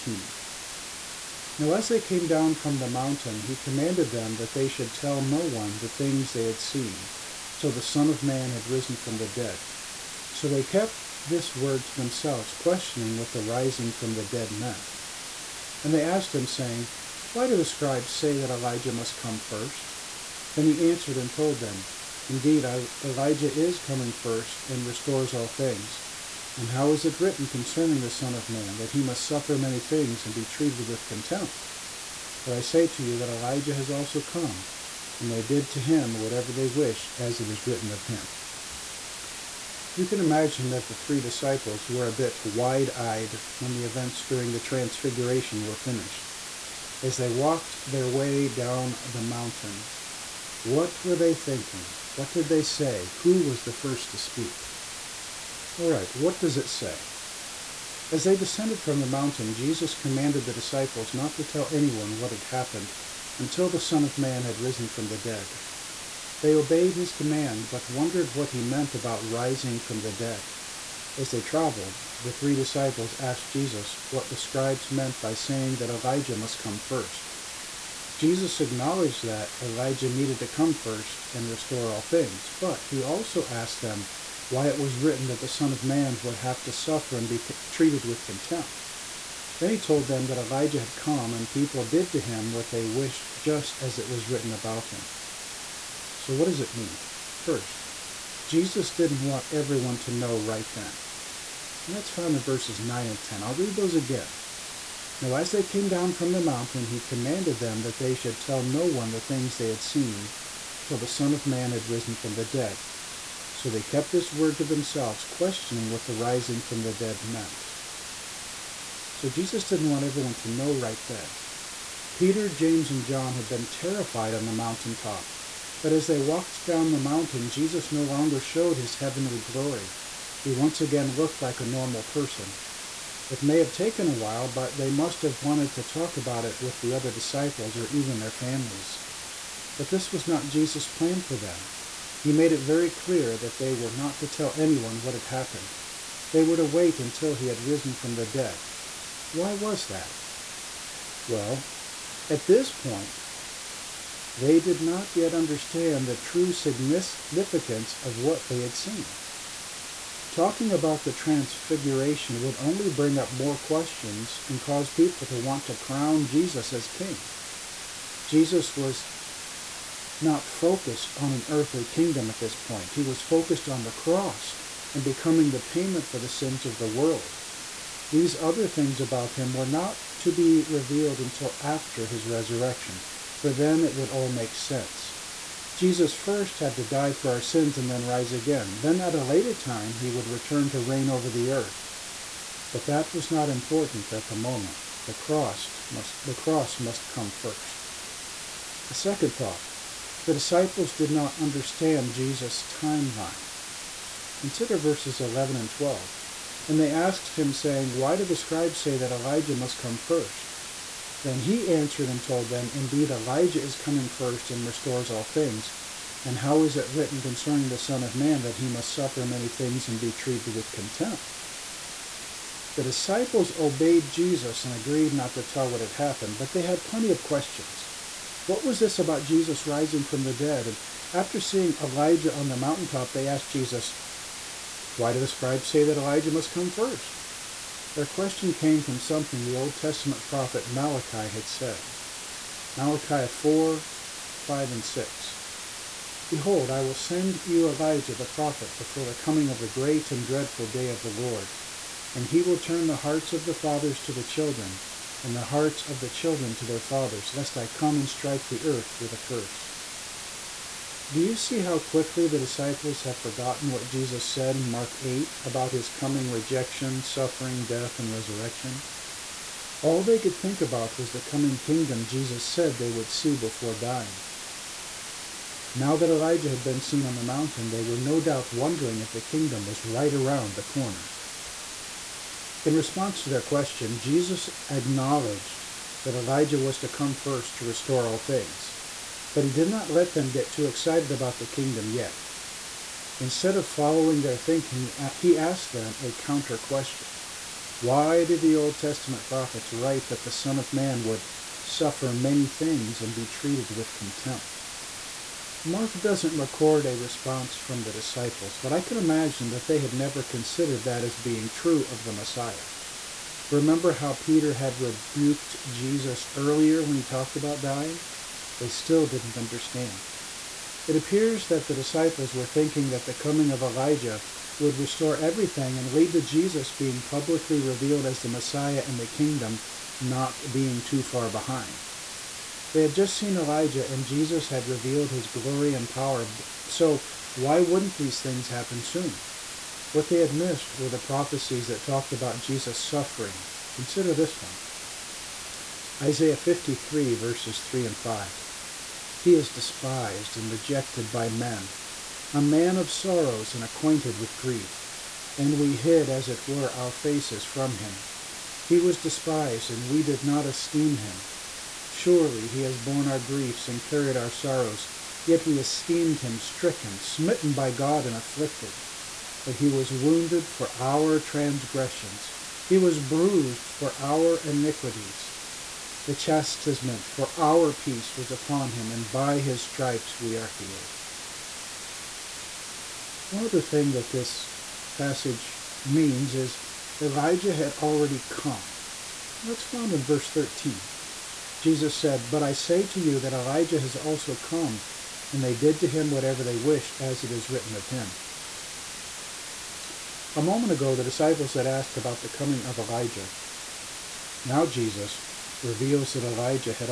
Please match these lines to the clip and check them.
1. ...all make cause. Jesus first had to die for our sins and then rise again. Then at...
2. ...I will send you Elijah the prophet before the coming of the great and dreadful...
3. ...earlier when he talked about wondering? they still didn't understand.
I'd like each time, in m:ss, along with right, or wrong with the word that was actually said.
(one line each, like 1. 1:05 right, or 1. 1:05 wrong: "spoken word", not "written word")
1. 3:04 wrong: "sense", not "cause"
2. 4:06 right
3. 5:16 wrong: "dying", not "wondering".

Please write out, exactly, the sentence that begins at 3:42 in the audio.
The disciples obeyed Jesus and agreed not to tell what had happened, but they had plenty of questions.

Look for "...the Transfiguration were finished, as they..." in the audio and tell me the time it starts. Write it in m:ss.
0:44.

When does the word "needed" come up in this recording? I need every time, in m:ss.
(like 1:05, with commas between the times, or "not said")
1:20.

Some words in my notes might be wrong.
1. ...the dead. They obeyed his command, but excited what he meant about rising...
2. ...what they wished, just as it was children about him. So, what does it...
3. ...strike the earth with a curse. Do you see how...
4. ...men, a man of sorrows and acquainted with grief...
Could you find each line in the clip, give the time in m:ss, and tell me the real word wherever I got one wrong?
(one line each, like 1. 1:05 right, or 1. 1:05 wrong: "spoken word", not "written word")
1. 1:05 wrong: "wondered", not "excited"
2. 1:32 wrong: "written", not "children"
3. 4:18 right
4. 5:51 right.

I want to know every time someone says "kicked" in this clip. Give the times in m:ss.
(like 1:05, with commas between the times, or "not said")
not said.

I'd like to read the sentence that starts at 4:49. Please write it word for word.
But he did not let them get too excited about the kingdom yet.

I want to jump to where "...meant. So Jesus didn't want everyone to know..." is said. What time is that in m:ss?
1:57.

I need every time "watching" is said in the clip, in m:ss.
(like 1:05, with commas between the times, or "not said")
not said.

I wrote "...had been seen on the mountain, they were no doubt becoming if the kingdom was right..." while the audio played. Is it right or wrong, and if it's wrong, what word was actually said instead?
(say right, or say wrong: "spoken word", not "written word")
wrong: "wondering", not "becoming".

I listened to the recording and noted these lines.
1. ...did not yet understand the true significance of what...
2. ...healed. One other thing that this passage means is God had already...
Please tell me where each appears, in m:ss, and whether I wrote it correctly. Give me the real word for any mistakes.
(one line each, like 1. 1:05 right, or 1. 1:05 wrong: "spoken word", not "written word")
1. 2:34 right
2. 6:20 wrong: "Elijah", not "God".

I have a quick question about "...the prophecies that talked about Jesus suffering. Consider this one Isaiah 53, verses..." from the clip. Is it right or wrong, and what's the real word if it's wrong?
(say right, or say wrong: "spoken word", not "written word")
right.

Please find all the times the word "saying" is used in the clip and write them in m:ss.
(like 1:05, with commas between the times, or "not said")
0:16, 1:15, 3:27.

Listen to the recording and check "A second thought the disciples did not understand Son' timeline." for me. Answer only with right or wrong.
wrong.